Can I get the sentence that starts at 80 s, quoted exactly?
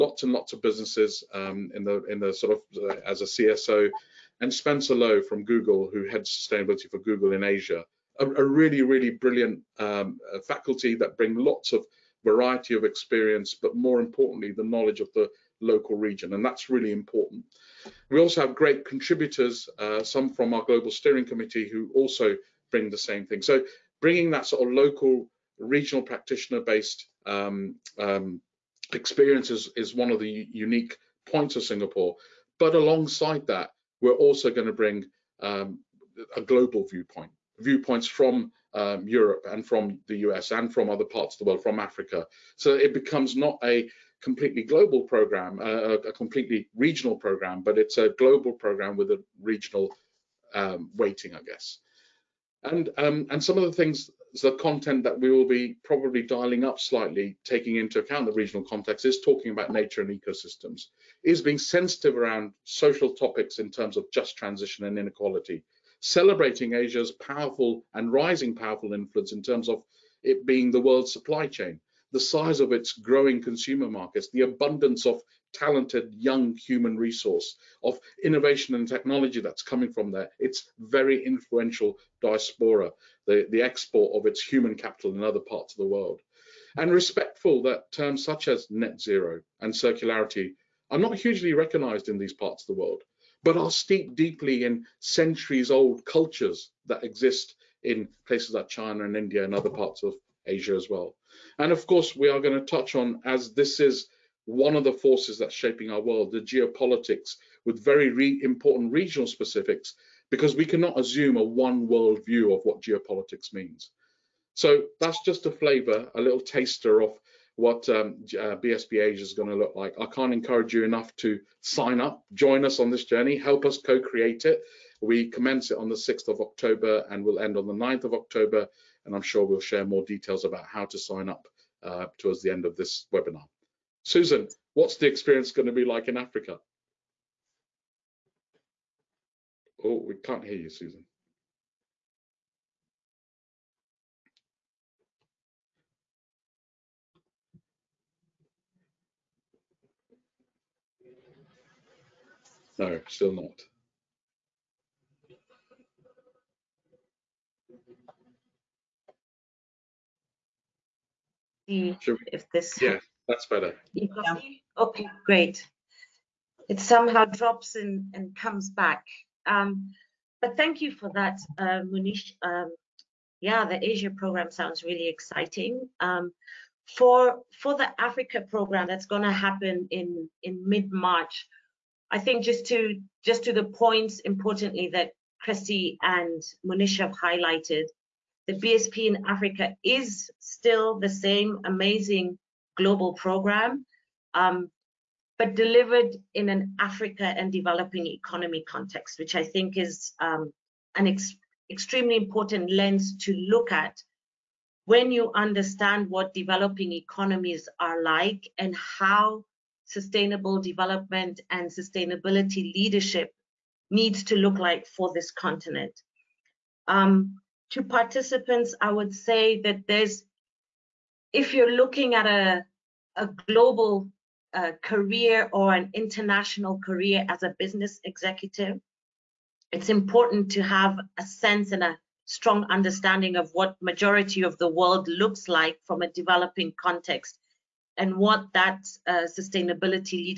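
It's very influential diaspora the, the export of its human capital in other parts of the world.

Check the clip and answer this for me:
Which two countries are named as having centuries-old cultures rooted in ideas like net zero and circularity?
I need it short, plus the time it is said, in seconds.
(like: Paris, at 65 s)
China and India, at 98 s.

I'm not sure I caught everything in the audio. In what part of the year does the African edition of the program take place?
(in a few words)
mid March.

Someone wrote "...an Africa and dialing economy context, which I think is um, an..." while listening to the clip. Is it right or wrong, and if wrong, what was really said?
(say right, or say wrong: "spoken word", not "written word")
wrong: "developing", not "dialing".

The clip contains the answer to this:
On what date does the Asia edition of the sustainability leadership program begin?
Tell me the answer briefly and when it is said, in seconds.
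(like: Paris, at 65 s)
6th of October, at 125 s.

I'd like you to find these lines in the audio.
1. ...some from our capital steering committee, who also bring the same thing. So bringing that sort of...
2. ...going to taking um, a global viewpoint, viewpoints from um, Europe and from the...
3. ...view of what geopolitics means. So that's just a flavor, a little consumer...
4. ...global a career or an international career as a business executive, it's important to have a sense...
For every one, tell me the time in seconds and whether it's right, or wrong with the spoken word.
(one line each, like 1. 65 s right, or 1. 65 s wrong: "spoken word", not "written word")
1. 20 s wrong: "global", not "capital"
2. 34 s wrong: "bring", not "taking"
3. 112 s wrong: "taster", not "consumer"
4. 223 s right.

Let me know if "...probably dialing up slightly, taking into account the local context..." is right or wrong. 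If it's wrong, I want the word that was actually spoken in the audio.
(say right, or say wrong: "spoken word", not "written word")
wrong: "regional", not "local".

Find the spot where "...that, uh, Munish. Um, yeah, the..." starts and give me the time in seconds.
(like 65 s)
171 s.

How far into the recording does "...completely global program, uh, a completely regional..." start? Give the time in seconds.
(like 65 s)
44 s.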